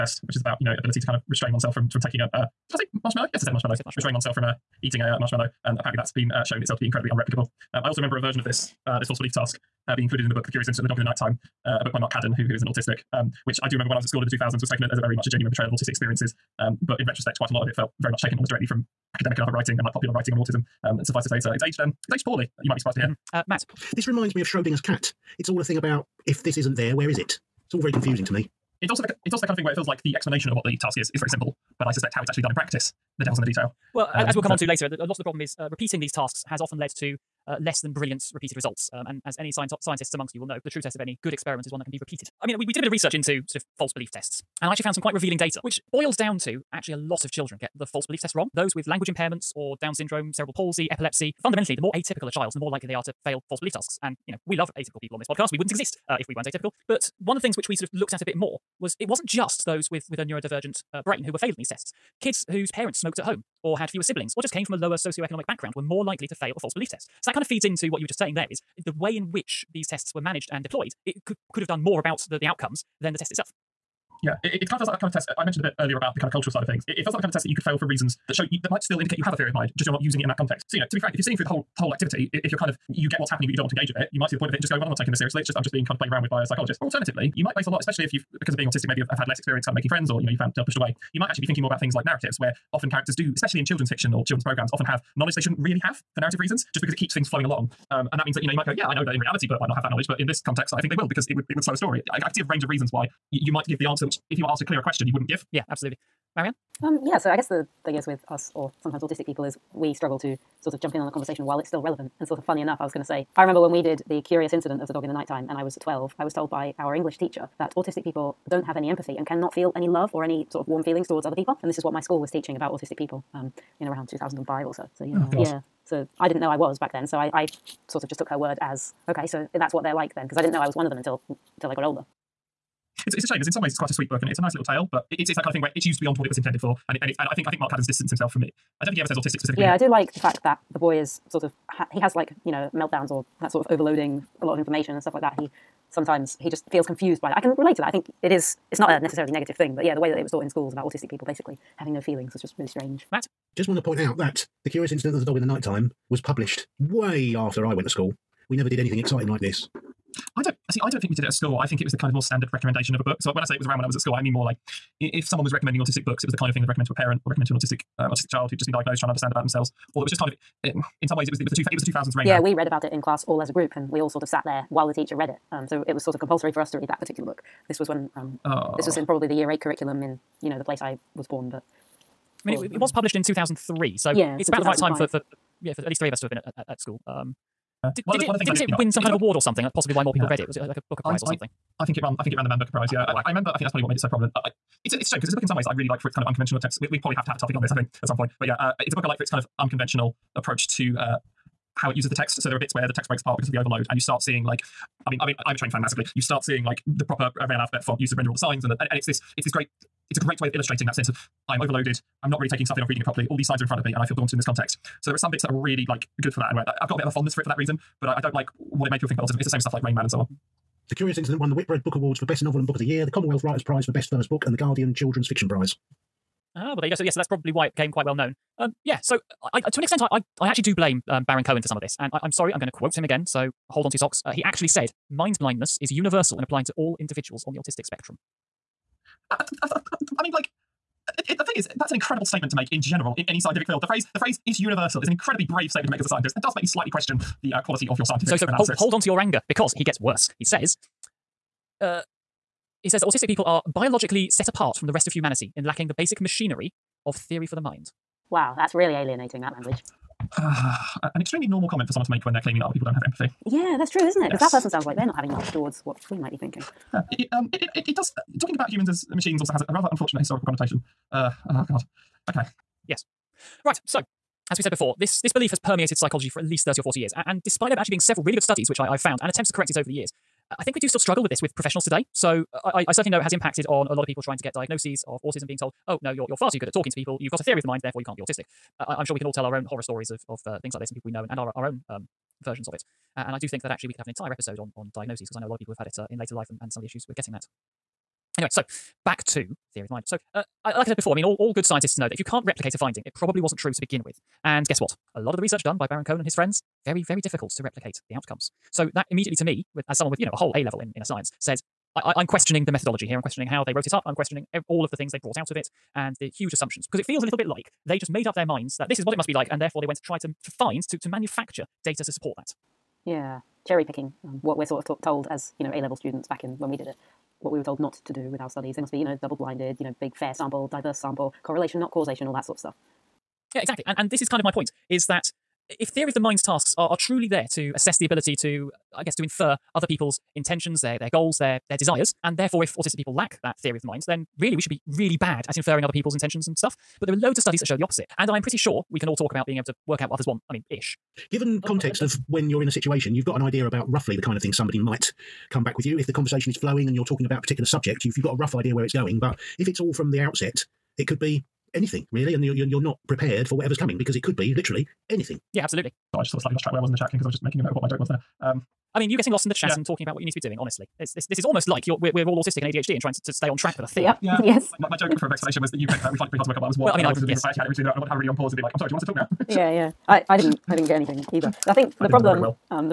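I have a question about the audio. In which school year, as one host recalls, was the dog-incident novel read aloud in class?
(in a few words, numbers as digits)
Year eight.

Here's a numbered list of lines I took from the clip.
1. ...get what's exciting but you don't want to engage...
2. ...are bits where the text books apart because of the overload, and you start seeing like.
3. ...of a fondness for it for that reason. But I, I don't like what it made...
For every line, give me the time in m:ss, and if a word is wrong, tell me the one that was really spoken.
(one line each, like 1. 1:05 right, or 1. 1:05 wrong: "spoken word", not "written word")
1. 1:23 wrong: "happening", not "exciting"
2. 3:22 wrong: "breaks", not "books"
3. 3:37 right.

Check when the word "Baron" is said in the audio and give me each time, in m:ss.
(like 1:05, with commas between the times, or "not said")
3:51, 5:05.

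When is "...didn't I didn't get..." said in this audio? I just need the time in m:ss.
6:20.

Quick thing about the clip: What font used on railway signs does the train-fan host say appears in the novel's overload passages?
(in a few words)
Rail alphabet.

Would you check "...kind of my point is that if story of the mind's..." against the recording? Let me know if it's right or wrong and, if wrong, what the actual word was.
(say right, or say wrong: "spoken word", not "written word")
wrong: "theory", not "story".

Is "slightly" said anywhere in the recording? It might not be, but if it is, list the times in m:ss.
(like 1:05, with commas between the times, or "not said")
4:06, 6:06.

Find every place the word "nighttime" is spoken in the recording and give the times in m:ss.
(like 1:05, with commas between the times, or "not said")
0:11, 1:55, 2:35.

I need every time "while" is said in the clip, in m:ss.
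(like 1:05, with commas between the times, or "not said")
1:51, 2:54.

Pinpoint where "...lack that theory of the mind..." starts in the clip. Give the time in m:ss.
5:43.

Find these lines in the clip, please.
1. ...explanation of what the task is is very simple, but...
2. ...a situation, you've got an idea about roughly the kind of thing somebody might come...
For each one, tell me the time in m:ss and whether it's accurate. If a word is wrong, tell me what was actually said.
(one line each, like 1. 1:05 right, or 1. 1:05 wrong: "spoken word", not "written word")
1. 0:30 right
2. 5:52 right.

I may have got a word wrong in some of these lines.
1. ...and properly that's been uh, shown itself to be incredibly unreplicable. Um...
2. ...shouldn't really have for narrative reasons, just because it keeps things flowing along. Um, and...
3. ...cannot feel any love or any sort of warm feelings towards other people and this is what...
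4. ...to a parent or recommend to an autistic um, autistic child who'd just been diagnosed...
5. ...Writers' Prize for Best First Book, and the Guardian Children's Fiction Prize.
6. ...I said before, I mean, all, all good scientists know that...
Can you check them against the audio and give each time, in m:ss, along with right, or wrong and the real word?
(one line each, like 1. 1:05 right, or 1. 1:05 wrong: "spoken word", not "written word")
1. 0:05 wrong: "apparently", not "properly"
2. 1:35 right
3. 1:59 right
4. 2:46 right
5. 3:43 right
6. 5:00 right.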